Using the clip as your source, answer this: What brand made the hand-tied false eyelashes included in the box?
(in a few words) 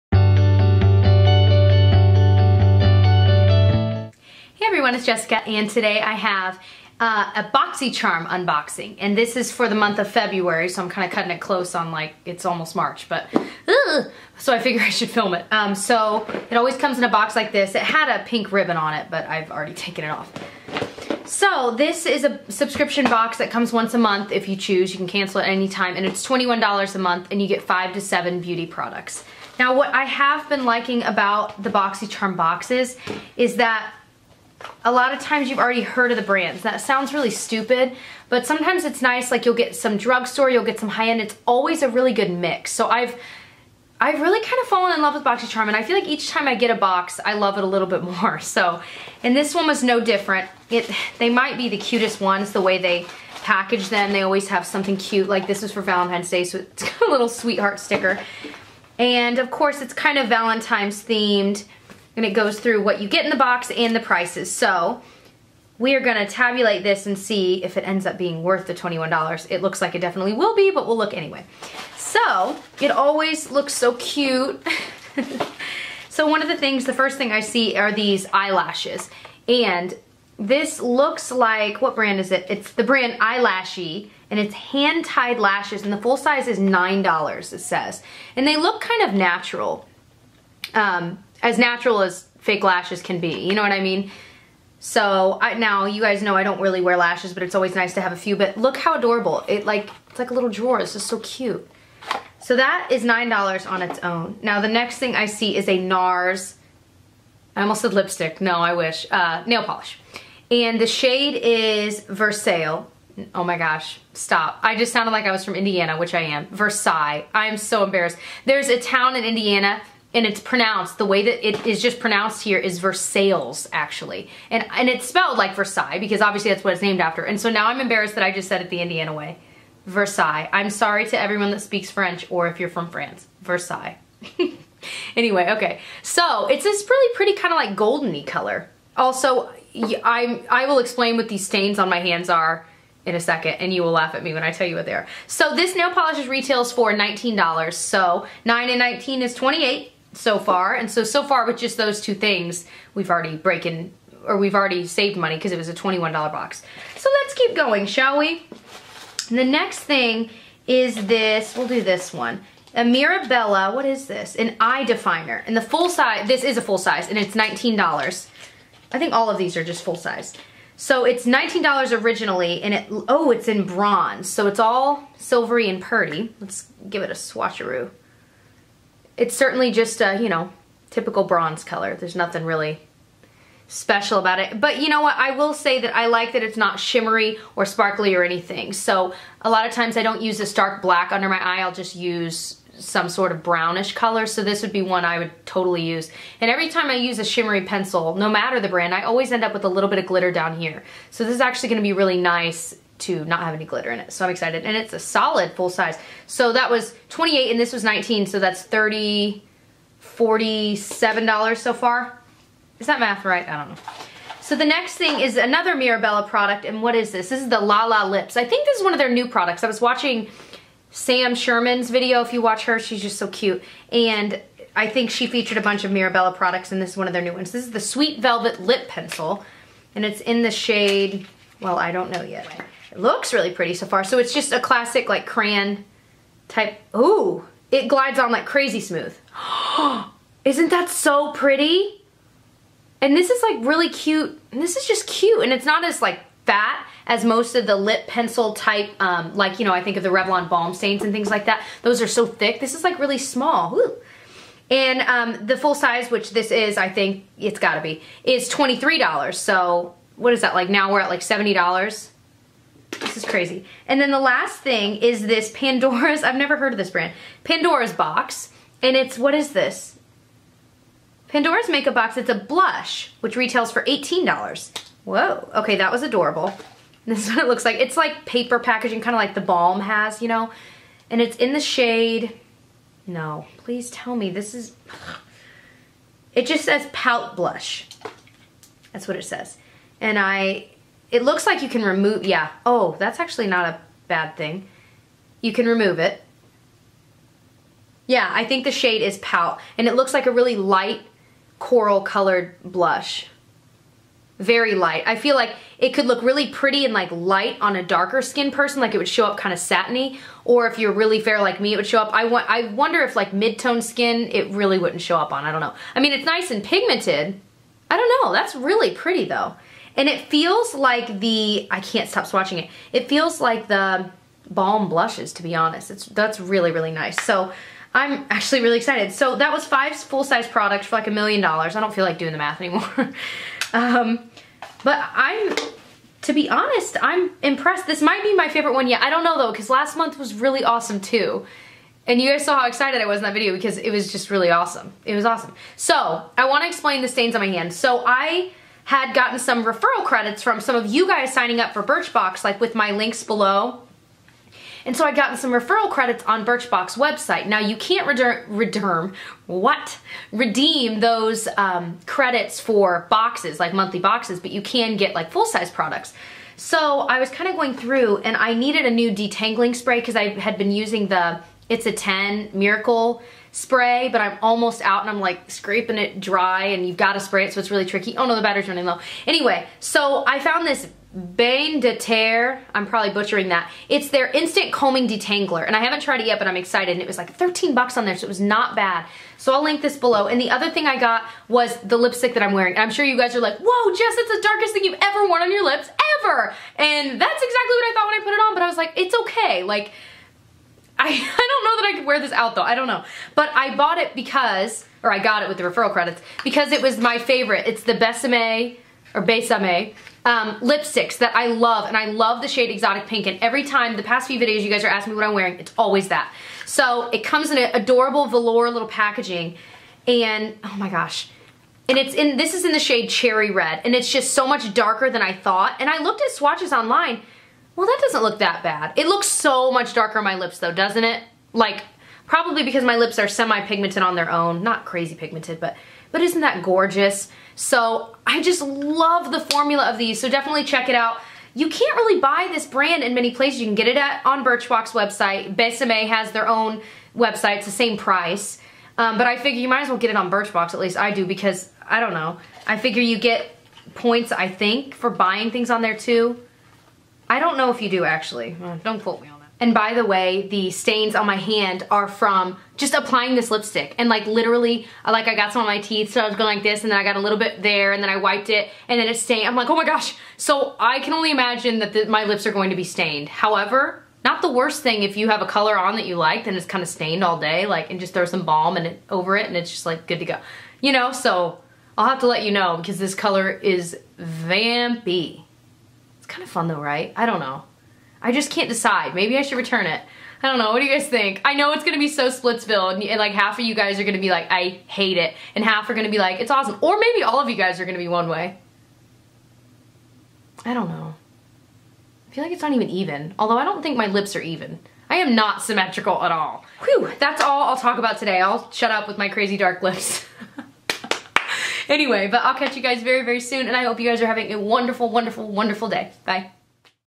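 Eyelashy.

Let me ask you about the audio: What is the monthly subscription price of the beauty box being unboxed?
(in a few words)
$21.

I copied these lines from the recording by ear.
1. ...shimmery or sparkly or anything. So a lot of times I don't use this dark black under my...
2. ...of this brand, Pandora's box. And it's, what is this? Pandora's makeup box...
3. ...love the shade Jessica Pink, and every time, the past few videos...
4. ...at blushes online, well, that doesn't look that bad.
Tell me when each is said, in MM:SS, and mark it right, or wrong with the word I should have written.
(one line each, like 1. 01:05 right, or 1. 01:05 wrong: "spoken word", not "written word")
1. 03:06 right
2. 04:26 right
3. 06:52 wrong: "Exotic", not "Jessica"
4. 07:06 wrong: "swatches", not "blushes".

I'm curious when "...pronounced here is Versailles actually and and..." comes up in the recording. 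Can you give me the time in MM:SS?
02:01.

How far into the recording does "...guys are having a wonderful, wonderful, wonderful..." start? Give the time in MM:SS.
08:34.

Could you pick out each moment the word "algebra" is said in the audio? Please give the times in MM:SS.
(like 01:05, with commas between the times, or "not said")
not said.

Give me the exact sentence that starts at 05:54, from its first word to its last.
And so I'd gotten some referral credits on Birchbox website.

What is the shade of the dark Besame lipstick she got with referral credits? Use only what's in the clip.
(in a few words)
Cherry Red.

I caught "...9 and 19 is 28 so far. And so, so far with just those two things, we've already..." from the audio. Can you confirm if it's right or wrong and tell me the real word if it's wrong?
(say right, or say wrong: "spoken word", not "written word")
right.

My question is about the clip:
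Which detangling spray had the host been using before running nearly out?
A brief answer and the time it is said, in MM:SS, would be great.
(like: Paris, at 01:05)
It's a 10 Miracle spray, at 06:11.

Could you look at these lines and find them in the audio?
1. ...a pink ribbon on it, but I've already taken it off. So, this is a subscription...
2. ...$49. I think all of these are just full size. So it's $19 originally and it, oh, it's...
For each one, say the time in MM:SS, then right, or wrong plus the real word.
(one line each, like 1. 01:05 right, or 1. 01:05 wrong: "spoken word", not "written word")
1. 00:18 right
2. 02:47 wrong: "19", not "49".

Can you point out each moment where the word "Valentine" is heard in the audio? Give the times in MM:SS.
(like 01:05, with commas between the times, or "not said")
00:55, 01:00.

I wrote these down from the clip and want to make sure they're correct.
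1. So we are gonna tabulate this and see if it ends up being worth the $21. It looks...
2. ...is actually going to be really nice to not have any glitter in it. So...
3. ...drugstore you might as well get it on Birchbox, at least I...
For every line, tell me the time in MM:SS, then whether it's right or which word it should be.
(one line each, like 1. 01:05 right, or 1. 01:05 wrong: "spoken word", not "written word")
1. 01:04 right
2. 03:21 right
3. 07:29 wrong: "figure", not "drugstore".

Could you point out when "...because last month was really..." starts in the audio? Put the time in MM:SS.
05:39.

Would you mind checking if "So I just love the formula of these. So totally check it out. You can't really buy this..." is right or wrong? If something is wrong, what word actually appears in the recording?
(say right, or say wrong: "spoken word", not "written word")
wrong: "definitely", not "totally".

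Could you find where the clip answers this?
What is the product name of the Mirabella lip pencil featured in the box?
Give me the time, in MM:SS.
03:47.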